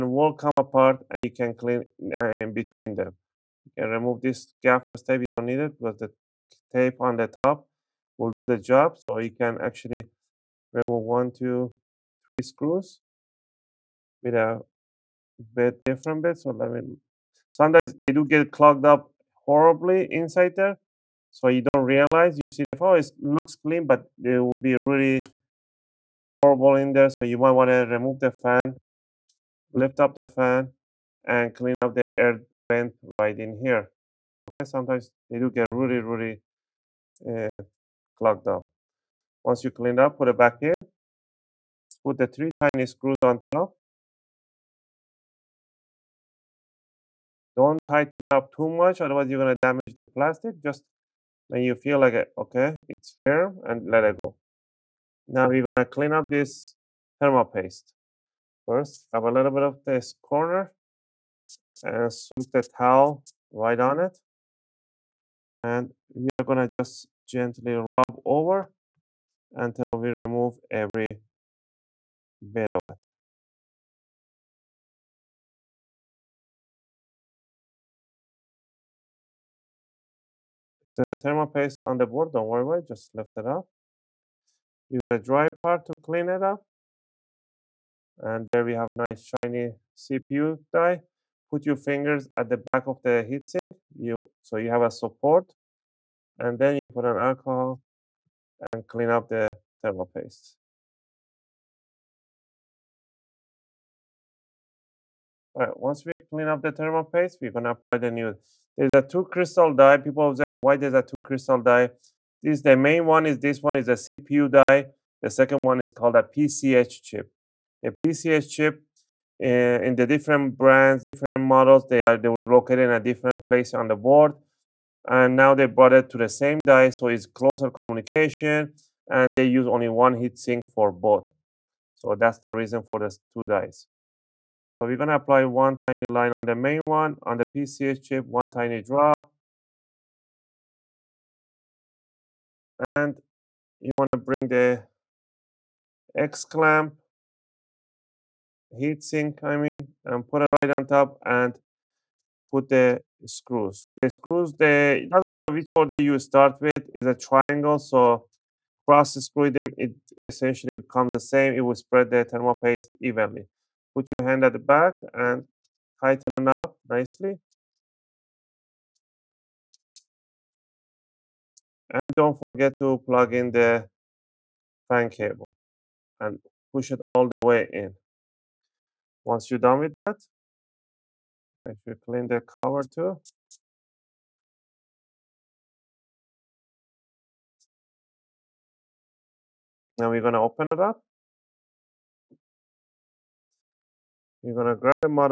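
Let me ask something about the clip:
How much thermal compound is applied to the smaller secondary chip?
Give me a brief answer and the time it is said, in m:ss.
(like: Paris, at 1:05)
One tiny drop, at 2:18.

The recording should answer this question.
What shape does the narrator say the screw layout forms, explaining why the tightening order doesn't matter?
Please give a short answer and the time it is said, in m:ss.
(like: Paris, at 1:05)
Triangle, at 2:37.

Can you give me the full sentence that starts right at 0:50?
Just when you feel like, it, okay, it's firm and let it go.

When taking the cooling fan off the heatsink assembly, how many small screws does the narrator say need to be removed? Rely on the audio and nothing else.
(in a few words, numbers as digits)
3.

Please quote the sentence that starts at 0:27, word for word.
So you might want to remove the fan, lift up the fan, and clean up the air vent right in here.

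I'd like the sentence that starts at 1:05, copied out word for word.
And we are going to just gently rub over until we remove every bit of it.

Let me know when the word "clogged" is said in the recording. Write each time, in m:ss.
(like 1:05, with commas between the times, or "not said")
0:18, 0:38.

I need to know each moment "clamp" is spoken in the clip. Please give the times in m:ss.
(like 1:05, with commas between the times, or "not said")
2:26.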